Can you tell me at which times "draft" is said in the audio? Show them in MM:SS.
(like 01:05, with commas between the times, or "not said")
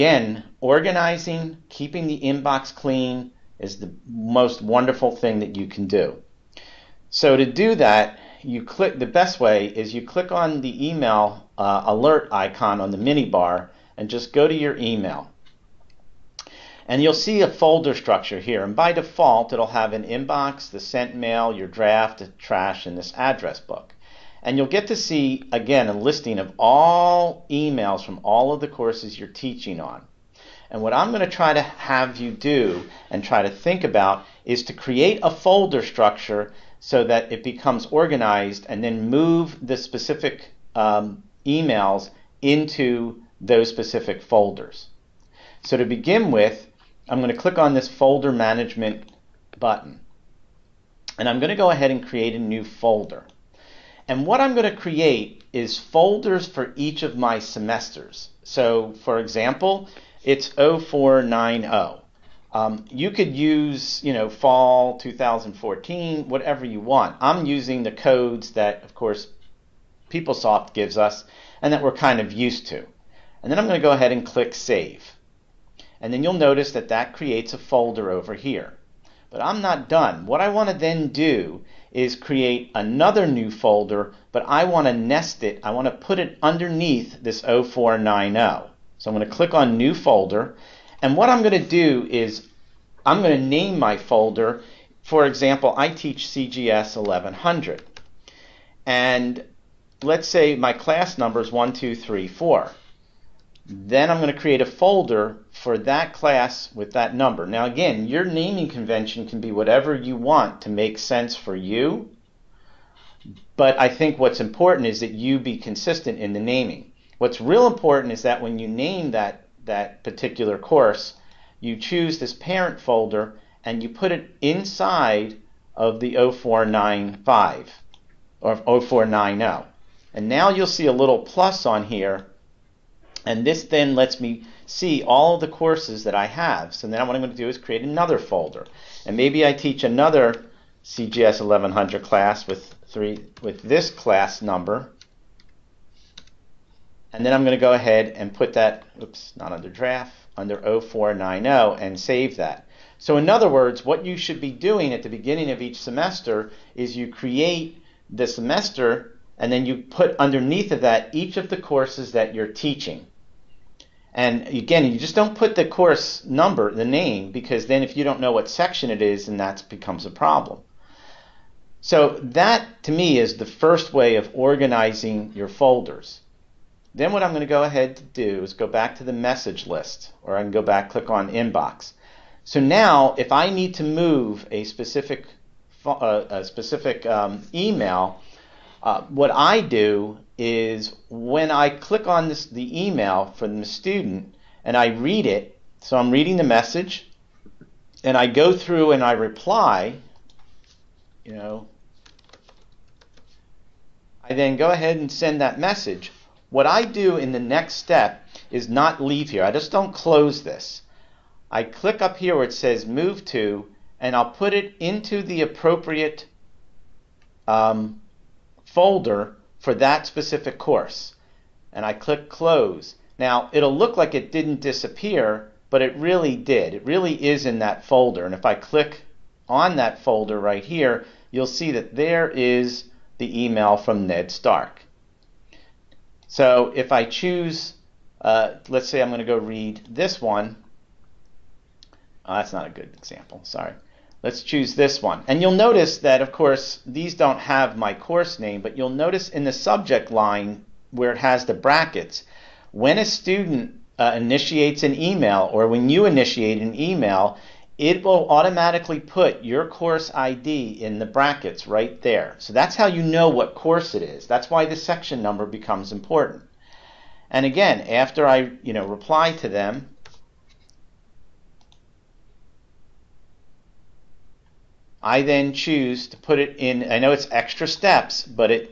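00:21, 02:29.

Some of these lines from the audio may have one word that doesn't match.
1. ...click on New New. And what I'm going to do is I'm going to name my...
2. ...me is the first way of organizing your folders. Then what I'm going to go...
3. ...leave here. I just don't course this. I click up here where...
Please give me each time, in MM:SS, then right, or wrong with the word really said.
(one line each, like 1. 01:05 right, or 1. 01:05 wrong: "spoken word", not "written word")
1. 01:29 wrong: "Folder", not "New"
2. 02:52 right
3. 03:29 wrong: "close", not "course".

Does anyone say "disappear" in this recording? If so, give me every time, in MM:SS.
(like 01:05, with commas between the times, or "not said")
03:44.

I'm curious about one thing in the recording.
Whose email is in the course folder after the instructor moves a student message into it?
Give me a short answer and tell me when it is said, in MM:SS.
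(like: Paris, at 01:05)
Ned Stark, at 03:54.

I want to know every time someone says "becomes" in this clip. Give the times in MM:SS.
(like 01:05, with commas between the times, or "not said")
00:37, 02:49, 04:25.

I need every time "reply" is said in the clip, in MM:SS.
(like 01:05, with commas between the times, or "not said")
03:19, 04:28.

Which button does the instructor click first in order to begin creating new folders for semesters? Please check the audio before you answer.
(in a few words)
folder management.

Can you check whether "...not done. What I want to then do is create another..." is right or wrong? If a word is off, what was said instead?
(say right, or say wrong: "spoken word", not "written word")
right.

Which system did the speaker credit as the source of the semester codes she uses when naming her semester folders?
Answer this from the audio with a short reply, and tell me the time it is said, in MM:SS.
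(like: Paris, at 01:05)
PeopleSoft, at 01:10.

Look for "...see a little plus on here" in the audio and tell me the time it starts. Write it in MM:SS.
02:10.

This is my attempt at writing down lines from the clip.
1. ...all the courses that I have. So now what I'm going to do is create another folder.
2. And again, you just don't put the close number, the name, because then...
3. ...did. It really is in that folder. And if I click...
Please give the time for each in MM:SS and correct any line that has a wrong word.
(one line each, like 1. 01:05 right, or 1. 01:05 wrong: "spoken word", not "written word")
1. 02:15 right
2. 02:44 wrong: "course", not "close"
3. 03:46 right.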